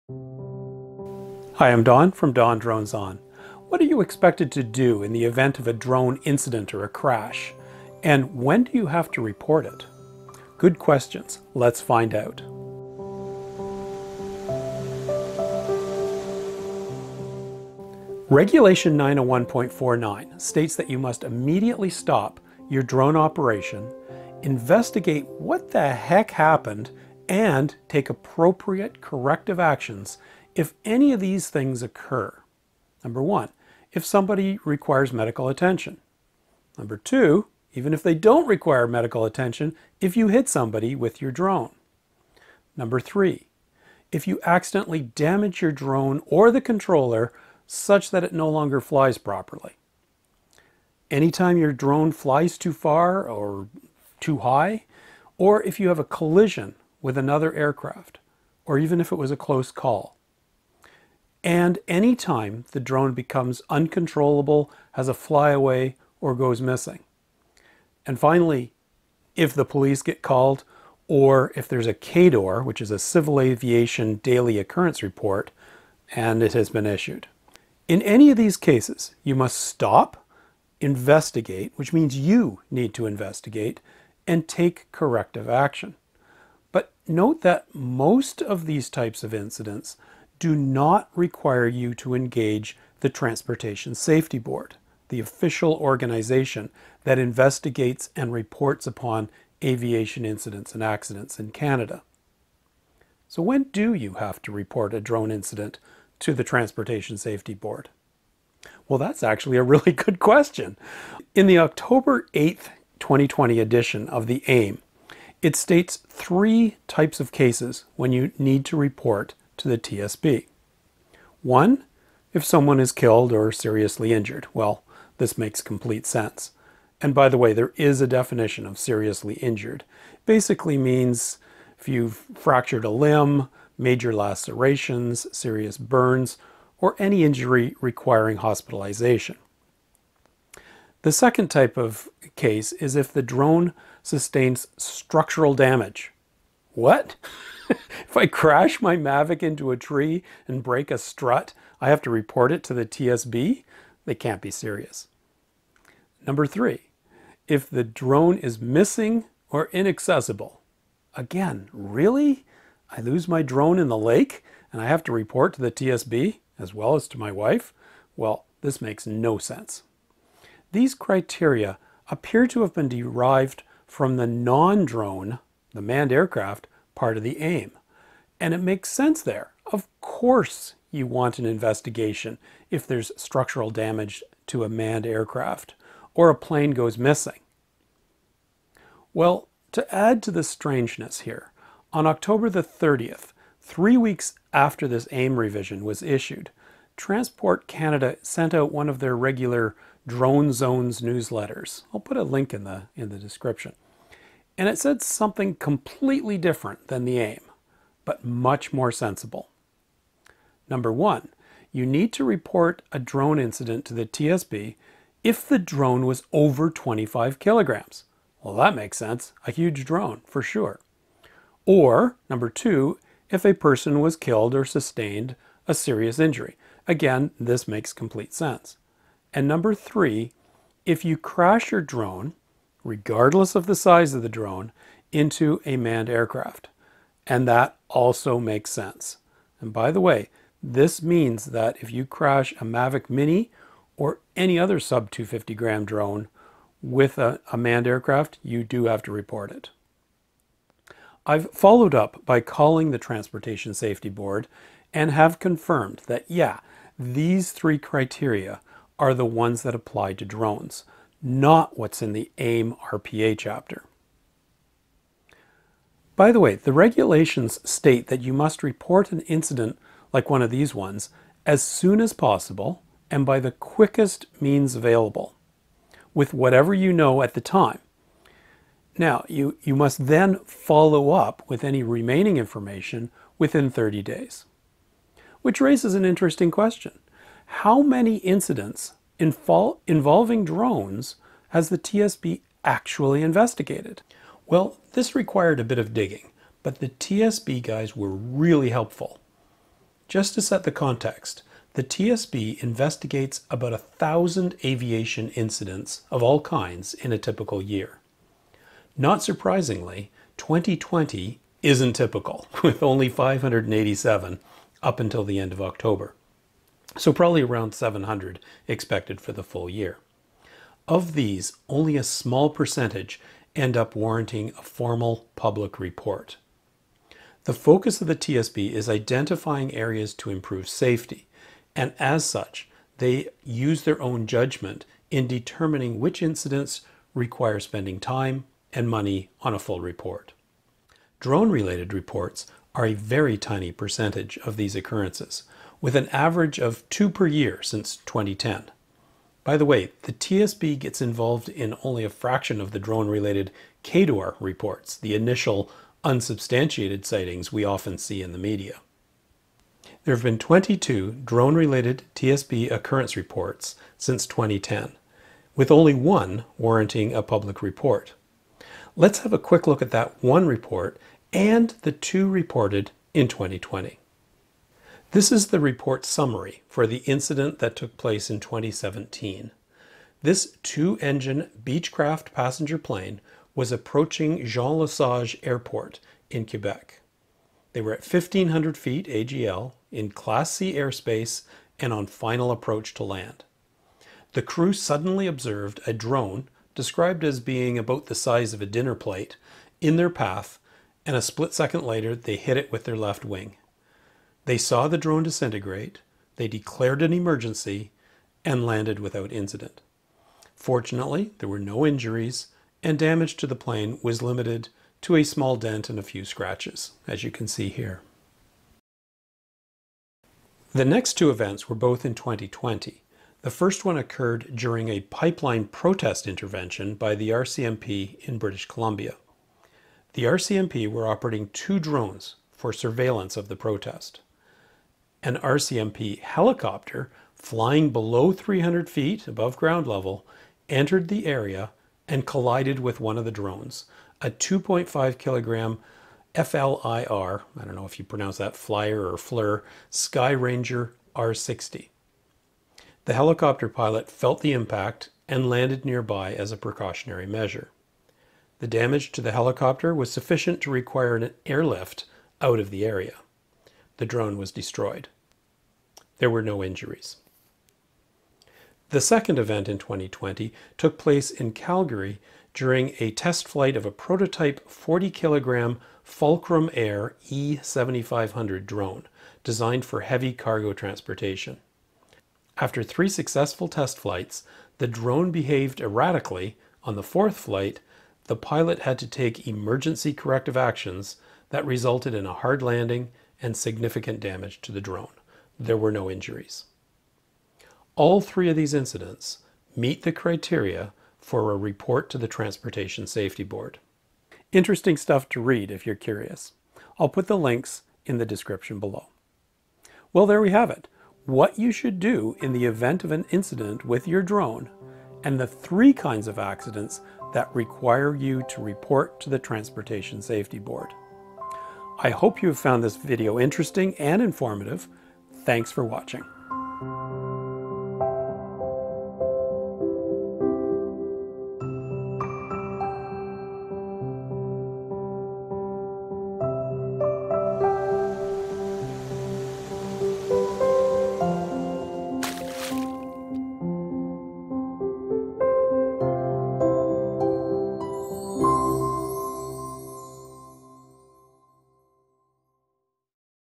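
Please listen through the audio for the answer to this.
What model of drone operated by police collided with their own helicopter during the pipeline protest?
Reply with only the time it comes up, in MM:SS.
07:29.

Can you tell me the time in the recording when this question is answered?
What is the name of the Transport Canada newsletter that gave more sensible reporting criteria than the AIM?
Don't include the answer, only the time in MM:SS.
03:20.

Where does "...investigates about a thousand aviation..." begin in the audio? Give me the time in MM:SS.
05:02.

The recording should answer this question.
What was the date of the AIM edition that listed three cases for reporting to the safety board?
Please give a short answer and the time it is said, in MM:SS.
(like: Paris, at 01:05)
October 8th, 2020, at 01:51.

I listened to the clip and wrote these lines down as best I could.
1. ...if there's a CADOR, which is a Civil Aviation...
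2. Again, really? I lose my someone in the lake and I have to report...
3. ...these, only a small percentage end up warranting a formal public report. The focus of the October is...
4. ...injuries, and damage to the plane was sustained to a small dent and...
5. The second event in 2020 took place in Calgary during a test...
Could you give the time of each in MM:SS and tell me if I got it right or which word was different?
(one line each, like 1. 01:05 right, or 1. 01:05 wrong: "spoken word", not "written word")
1. 01:11 right
2. 02:41 wrong: "drone", not "someone"
3. 05:21 wrong: "TSB", not "October"
4. 06:51 wrong: "limited", not "sustained"
5. 07:48 right.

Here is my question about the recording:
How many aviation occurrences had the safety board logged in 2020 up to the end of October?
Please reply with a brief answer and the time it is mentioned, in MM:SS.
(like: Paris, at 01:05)
587, at 05:13.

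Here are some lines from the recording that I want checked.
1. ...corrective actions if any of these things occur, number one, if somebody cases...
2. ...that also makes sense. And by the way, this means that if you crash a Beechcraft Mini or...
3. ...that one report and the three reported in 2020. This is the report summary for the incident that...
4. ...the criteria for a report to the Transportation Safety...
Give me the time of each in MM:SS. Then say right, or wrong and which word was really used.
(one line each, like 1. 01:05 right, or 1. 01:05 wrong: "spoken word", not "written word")
1. 00:28 wrong: "requires", not "cases"
2. 03:57 wrong: "Mavic", not "Beechcraft"
3. 06:09 wrong: "two", not "three"
4. 08:20 right.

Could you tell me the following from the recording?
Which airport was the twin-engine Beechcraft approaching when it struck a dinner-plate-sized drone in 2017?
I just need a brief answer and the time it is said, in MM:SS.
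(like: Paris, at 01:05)
Jean Lesage Airport, at 06:24.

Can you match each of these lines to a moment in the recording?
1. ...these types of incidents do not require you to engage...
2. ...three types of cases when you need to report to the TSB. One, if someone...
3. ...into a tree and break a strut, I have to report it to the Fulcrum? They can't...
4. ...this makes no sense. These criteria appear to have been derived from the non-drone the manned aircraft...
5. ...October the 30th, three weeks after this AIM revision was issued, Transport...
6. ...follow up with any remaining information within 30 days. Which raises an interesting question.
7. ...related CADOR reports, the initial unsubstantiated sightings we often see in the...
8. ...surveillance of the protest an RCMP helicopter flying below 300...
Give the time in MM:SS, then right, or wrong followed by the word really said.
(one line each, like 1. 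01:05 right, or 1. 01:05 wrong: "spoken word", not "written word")
1. 01:28 right
2. 01:56 right
3. 02:29 wrong: "TSB", not "Fulcrum"
4. 02:48 right
5. 03:12 right
6. 04:40 right
7. 05:53 right
8. 07:12 right.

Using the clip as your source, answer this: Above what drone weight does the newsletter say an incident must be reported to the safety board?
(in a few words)
25 kilograms.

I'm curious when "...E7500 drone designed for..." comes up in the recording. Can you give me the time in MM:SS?
07:57.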